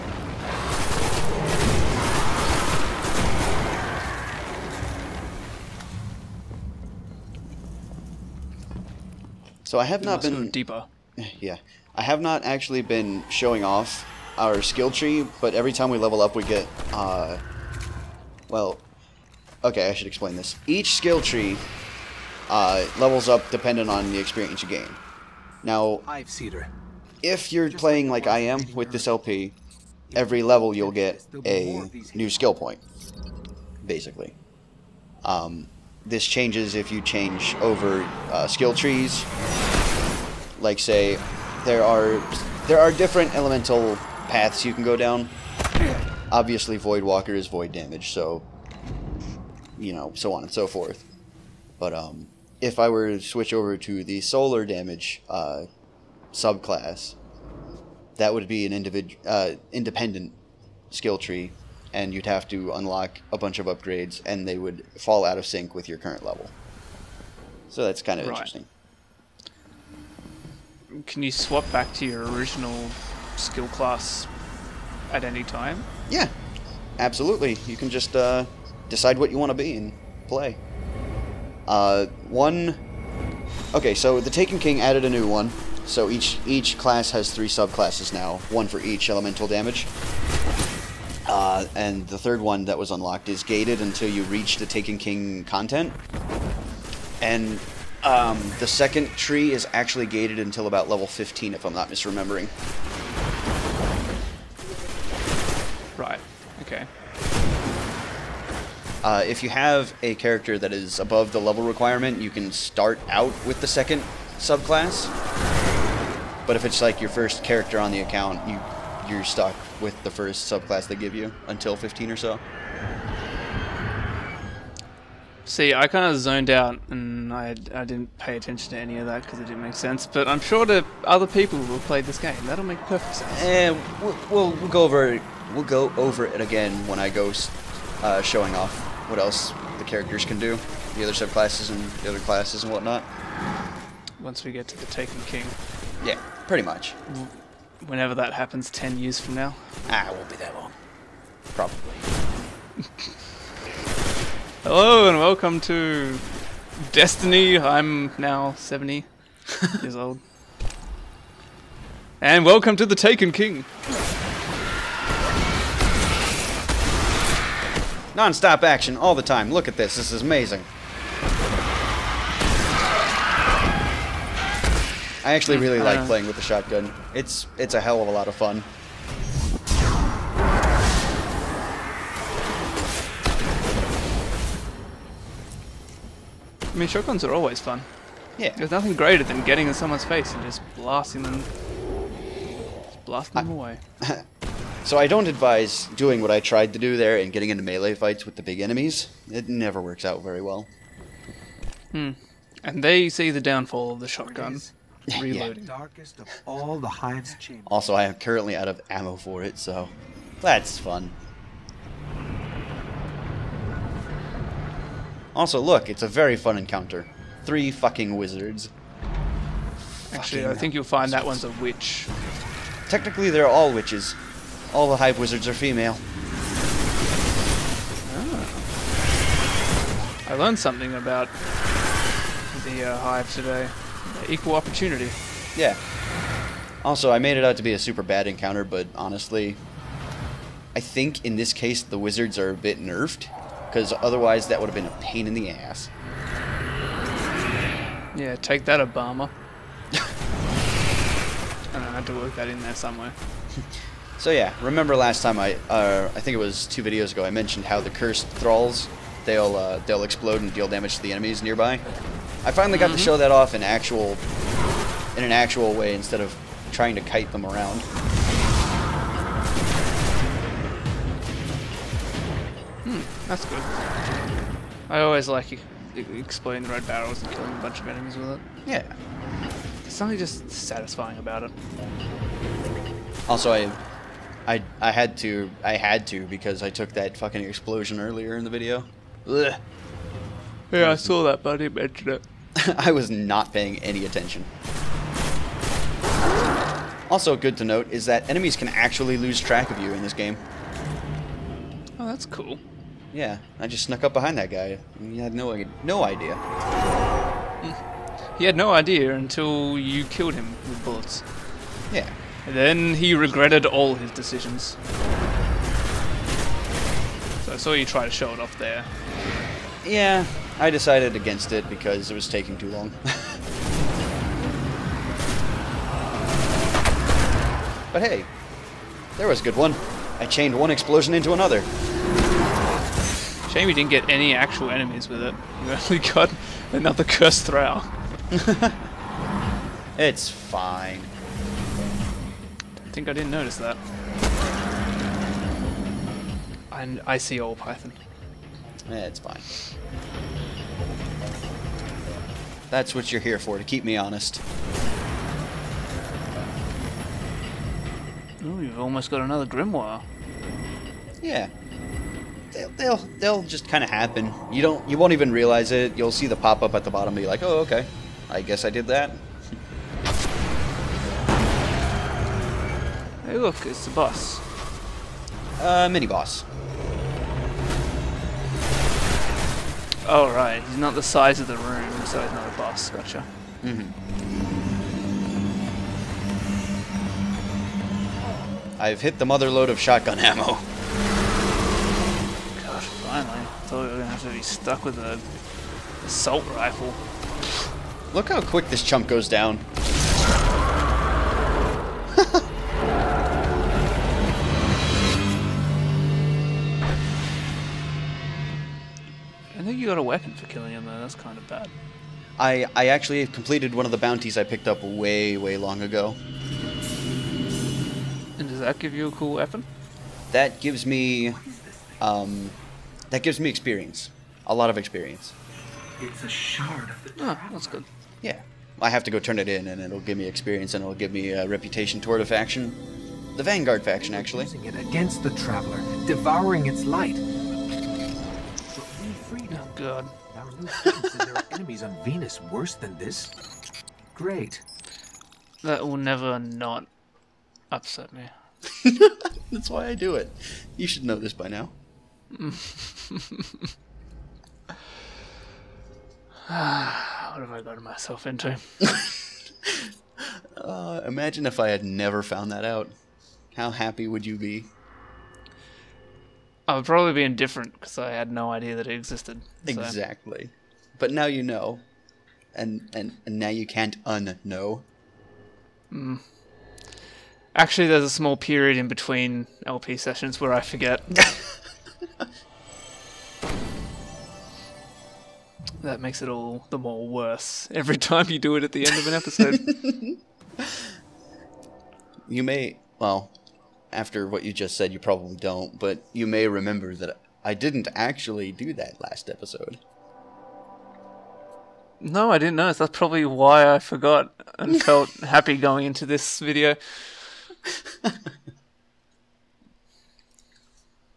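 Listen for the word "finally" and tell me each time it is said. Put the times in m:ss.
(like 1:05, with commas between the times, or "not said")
4:22, 6:33.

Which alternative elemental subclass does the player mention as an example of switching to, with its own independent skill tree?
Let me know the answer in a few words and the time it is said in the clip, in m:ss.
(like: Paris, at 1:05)
Solar, at 0:54.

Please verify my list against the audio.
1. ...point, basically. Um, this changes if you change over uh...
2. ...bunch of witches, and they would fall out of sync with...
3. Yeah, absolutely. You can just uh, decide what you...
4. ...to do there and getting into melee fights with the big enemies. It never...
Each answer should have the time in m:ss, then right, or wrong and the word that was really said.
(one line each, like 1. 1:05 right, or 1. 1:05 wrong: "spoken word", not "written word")
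1. 0:32 right
2. 1:03 wrong: "upgrades", not "witches"
3. 1:16 right
4. 3:16 right.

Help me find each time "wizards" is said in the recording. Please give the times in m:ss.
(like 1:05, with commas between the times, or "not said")
3:38, 3:45, 4:01.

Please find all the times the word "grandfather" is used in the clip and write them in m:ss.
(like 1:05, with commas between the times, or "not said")
not said.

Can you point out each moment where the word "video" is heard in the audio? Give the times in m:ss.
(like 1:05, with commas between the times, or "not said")
4:16, 4:48, 8:26.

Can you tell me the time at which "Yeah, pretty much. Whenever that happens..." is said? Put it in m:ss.
2:26.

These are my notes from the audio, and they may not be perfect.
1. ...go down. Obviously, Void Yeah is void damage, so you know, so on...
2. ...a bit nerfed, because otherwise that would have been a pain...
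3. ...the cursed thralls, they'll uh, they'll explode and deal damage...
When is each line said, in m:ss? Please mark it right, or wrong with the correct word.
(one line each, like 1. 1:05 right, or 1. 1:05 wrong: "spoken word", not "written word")
1. 0:44 wrong: "Walker", not "Yeah"
2. 4:02 right
3. 4:17 right.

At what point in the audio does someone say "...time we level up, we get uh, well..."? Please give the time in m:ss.
0:15.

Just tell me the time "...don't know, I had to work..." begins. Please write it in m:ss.
4:11.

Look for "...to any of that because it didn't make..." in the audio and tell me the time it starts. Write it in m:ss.
2:08.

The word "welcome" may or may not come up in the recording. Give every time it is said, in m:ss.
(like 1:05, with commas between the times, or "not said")
2:35, 2:42.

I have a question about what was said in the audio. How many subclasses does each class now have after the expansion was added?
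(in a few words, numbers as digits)
3.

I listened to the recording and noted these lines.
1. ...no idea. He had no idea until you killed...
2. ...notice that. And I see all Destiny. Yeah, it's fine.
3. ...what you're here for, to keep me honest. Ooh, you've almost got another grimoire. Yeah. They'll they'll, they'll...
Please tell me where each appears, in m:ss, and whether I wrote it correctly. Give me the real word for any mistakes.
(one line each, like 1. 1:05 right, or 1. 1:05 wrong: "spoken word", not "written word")
1. 5:05 right
2. 5:43 wrong: "Python", not "Destiny"
3. 5:52 right.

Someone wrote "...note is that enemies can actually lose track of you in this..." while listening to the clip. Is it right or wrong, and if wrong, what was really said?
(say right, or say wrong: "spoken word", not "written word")
right.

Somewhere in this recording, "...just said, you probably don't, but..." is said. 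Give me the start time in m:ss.
8:14.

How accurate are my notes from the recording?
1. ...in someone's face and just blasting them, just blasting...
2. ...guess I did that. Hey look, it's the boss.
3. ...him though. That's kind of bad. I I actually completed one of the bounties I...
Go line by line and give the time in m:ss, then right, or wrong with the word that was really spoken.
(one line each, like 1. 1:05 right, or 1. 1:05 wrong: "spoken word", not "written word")
1. 3:09 right
2. 6:08 right
3. 6:50 right.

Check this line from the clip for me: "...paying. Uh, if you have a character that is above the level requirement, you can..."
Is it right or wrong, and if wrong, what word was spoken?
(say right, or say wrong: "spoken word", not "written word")
wrong: "misremembering", not "paying".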